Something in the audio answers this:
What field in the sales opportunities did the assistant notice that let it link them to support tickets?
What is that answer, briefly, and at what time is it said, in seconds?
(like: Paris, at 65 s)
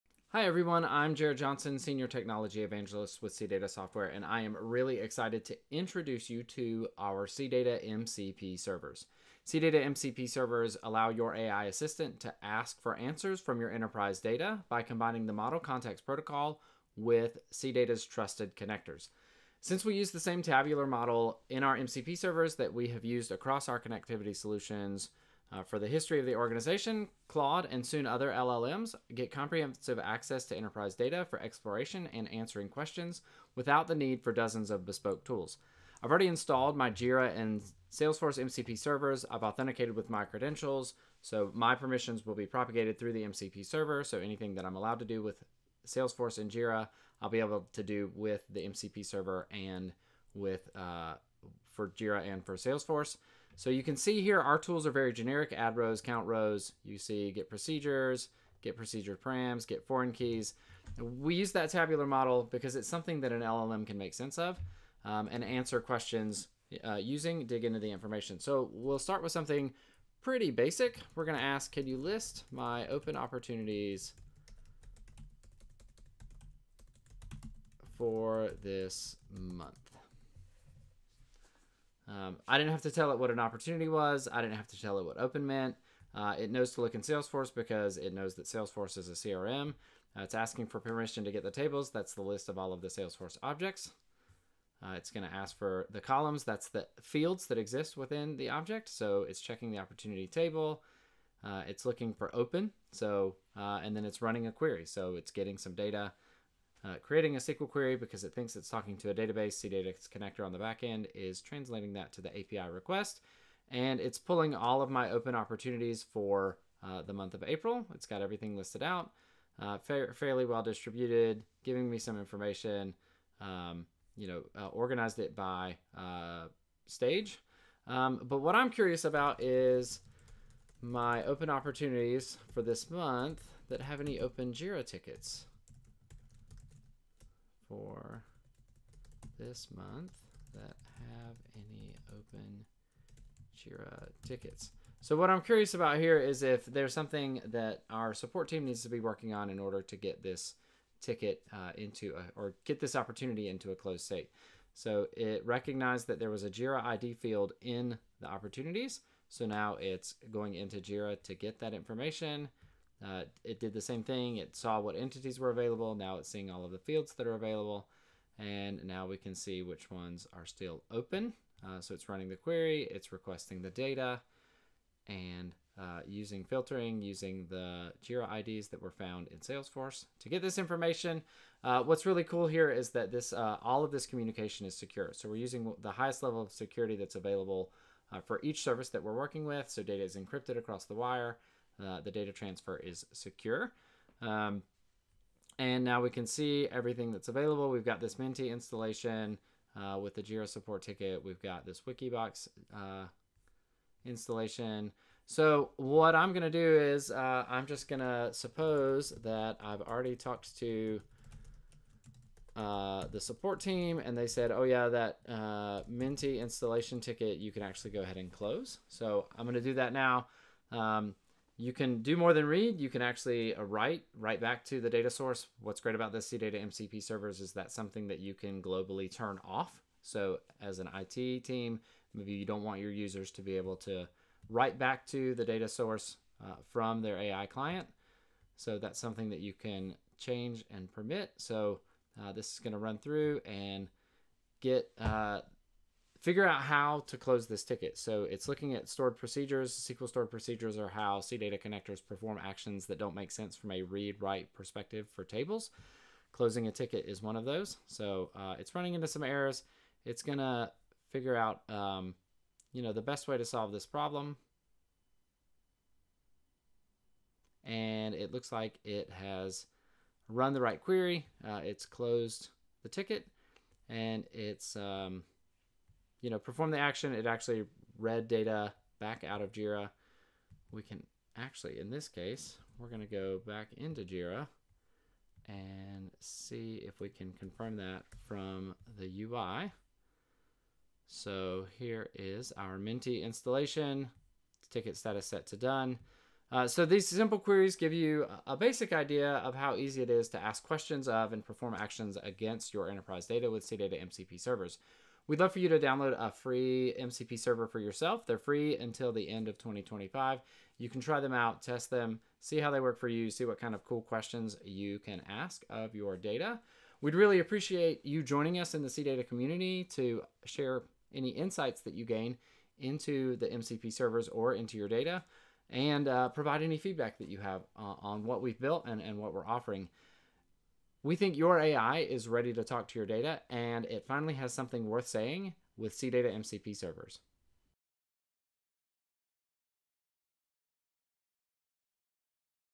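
JIRA ID, at 156 s.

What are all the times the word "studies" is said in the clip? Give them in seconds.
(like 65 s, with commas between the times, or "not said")
not said.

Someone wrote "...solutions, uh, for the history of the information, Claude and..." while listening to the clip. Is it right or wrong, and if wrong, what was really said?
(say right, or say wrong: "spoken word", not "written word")
wrong: "organization", not "information".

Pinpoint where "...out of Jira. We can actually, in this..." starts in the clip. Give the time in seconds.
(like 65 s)
279 s.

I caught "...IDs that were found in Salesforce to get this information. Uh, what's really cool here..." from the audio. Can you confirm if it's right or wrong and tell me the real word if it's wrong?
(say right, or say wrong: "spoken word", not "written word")
right.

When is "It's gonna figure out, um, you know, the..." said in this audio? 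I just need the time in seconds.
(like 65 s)
260 s.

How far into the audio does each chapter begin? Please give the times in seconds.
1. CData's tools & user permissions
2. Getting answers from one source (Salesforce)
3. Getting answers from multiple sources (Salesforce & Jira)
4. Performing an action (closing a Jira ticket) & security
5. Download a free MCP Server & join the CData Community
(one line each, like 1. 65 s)
1. 35 s
2. 68 s
3. 128 s
4. 205 s
5. 296 s.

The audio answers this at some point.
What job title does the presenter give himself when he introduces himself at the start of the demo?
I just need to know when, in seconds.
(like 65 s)
1 s.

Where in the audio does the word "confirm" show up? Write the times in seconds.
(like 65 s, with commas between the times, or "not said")
287 s.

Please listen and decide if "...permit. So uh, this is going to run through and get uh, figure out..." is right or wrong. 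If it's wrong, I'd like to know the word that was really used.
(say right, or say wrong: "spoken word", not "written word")
right.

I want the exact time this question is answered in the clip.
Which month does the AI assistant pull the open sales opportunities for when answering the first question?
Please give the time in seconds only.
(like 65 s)
117 s.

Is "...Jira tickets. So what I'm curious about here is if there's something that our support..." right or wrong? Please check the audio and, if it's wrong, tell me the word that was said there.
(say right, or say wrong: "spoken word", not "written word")
right.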